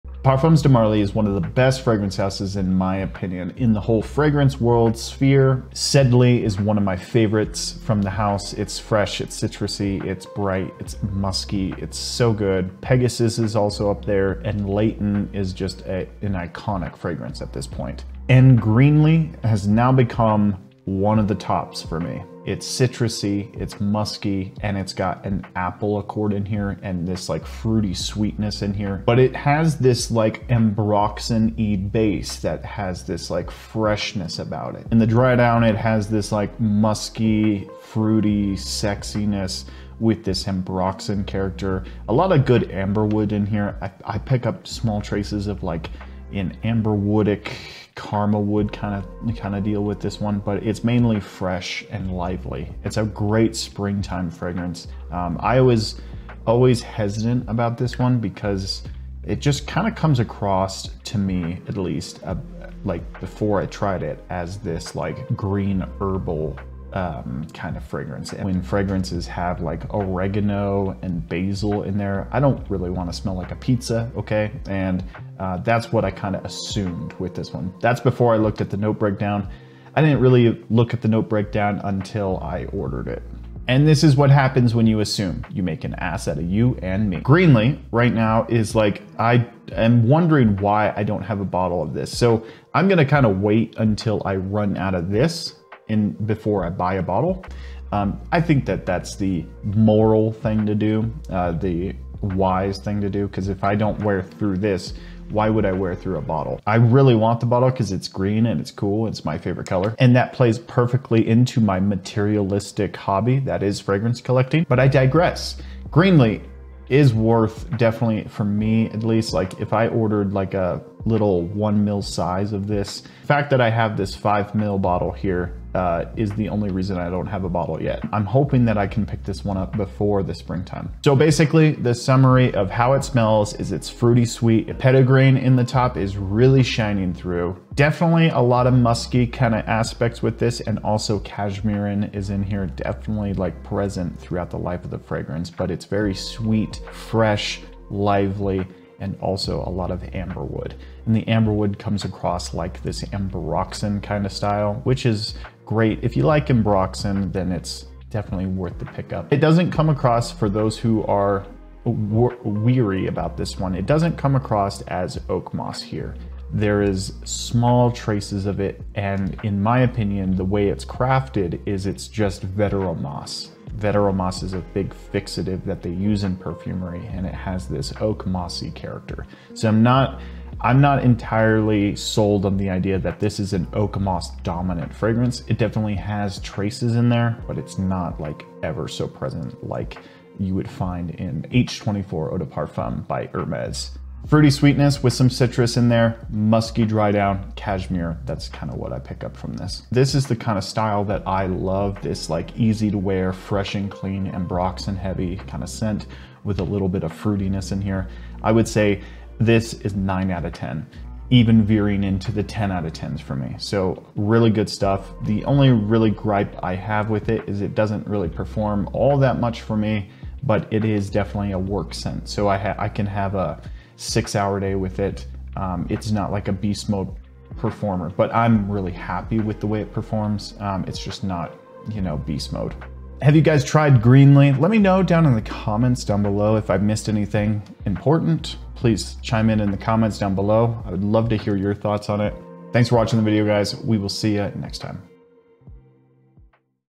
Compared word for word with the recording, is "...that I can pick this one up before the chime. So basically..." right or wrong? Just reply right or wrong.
wrong.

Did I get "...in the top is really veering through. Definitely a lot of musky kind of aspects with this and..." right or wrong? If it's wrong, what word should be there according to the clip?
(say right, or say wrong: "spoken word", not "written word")
wrong: "shining", not "veering".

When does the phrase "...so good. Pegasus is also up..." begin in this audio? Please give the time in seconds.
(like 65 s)
11 s.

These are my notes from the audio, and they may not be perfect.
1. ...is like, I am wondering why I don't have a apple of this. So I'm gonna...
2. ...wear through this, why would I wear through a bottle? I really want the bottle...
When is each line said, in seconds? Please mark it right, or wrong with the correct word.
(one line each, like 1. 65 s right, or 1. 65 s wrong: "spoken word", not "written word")
1. 88 s wrong: "bottle", not "apple"
2. 104 s right.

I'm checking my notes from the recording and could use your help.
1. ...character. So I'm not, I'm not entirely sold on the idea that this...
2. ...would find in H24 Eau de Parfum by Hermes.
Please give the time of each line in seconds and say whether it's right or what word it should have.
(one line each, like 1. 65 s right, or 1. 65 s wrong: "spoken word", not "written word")
1. 178 s right
2. 190 s right.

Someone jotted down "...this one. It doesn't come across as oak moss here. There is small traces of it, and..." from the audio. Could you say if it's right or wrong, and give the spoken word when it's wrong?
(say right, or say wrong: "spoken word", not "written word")
right.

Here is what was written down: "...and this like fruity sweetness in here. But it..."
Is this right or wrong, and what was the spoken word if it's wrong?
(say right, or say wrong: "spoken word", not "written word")
right.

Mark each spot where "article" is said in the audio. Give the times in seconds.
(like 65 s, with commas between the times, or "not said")
not said.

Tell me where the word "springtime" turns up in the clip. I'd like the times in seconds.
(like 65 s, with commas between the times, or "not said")
53 s, 130 s.